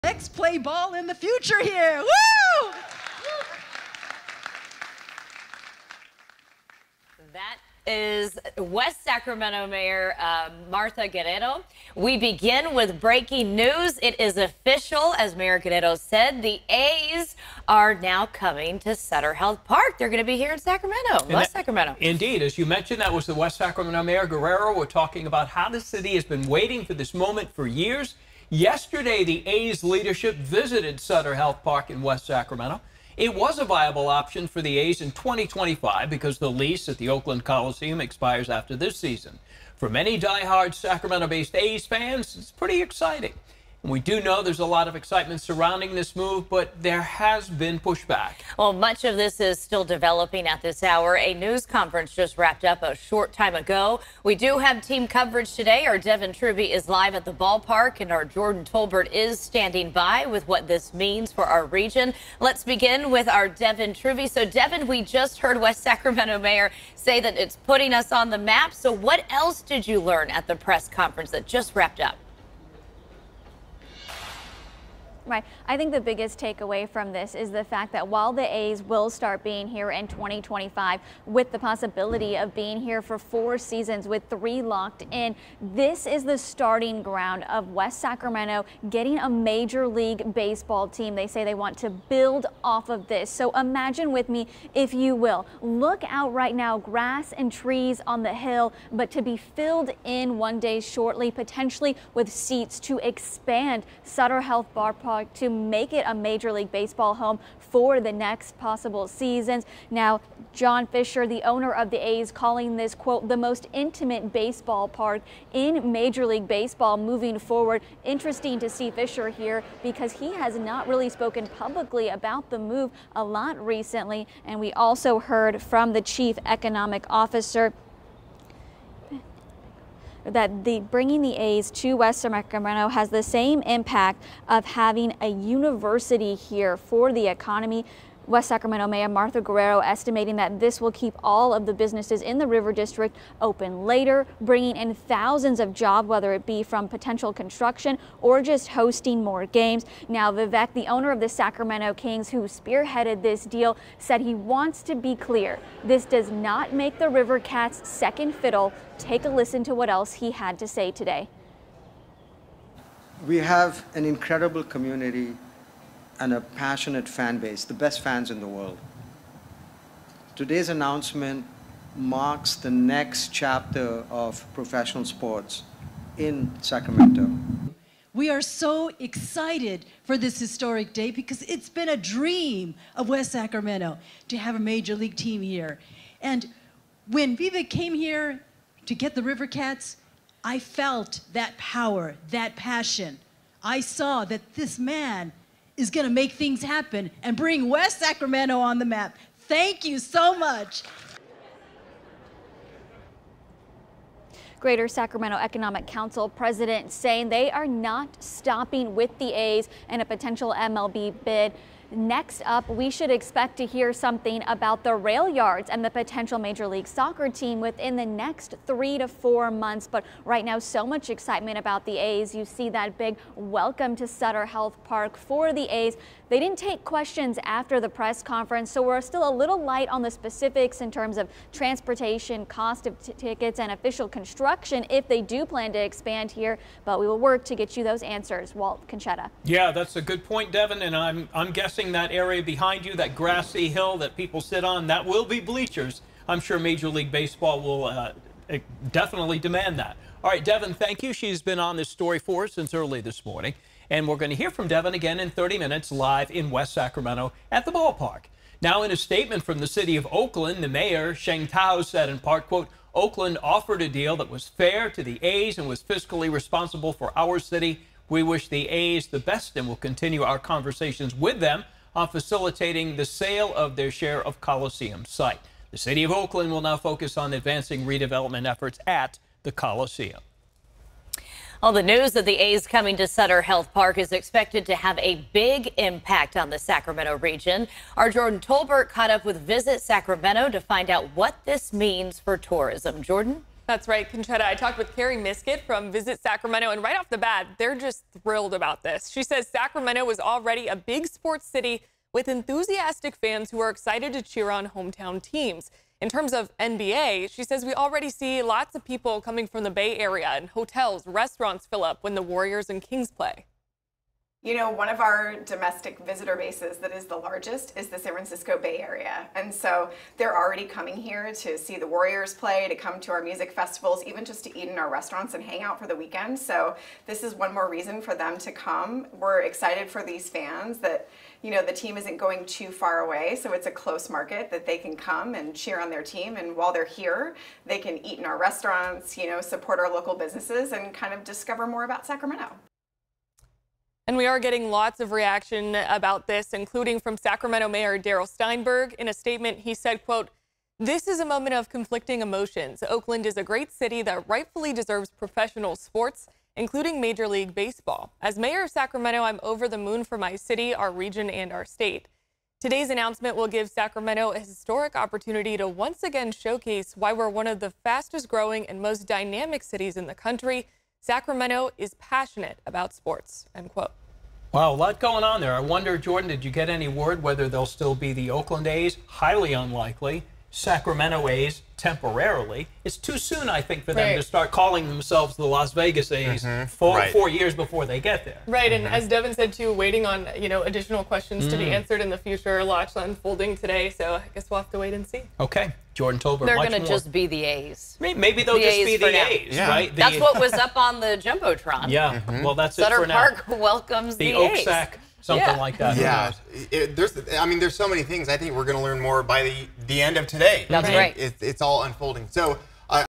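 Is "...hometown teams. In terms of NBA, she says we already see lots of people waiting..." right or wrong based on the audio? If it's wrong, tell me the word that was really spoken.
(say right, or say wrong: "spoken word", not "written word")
wrong: "coming", not "waiting".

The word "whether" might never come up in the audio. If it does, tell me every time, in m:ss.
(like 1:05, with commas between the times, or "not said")
2:26, 6:17.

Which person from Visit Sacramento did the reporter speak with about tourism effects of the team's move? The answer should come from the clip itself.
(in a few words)
Carrie Miskit.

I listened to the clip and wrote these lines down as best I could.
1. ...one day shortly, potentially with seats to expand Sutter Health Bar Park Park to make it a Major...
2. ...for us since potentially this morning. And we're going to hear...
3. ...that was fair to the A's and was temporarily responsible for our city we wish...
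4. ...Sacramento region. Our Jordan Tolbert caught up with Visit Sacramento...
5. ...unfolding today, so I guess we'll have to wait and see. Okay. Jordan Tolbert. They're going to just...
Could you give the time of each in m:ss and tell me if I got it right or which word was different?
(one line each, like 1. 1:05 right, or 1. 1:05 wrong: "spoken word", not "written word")
1. 1:40 right
2. 4:12 wrong: "early", not "potentially"
3. 4:24 wrong: "fiscally", not "temporarily"
4. 4:46 right
5. 6:32 right.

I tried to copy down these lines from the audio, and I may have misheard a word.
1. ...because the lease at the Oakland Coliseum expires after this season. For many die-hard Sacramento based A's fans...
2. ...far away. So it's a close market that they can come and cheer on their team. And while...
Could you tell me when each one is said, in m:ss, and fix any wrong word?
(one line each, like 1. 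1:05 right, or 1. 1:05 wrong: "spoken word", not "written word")
1. 0:36 right
2. 5:32 right.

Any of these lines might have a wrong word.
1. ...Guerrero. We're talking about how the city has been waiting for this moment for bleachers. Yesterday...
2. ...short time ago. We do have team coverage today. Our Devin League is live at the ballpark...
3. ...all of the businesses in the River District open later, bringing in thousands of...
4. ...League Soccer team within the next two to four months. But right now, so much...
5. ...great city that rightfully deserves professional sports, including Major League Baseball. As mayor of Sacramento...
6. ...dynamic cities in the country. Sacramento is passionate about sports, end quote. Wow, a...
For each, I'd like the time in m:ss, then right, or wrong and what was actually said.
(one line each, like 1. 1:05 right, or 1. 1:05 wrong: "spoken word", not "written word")
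1. 0:24 wrong: "years", not "bleachers"
2. 0:52 wrong: "Trubey", not "League"
3. 2:21 right
4. 3:36 wrong: "three", not "two"
5. 5:53 right
6. 6:09 right.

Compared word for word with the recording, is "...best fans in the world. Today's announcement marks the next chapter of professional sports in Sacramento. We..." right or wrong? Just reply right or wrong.
right.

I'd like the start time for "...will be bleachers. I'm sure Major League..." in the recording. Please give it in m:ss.
4:05.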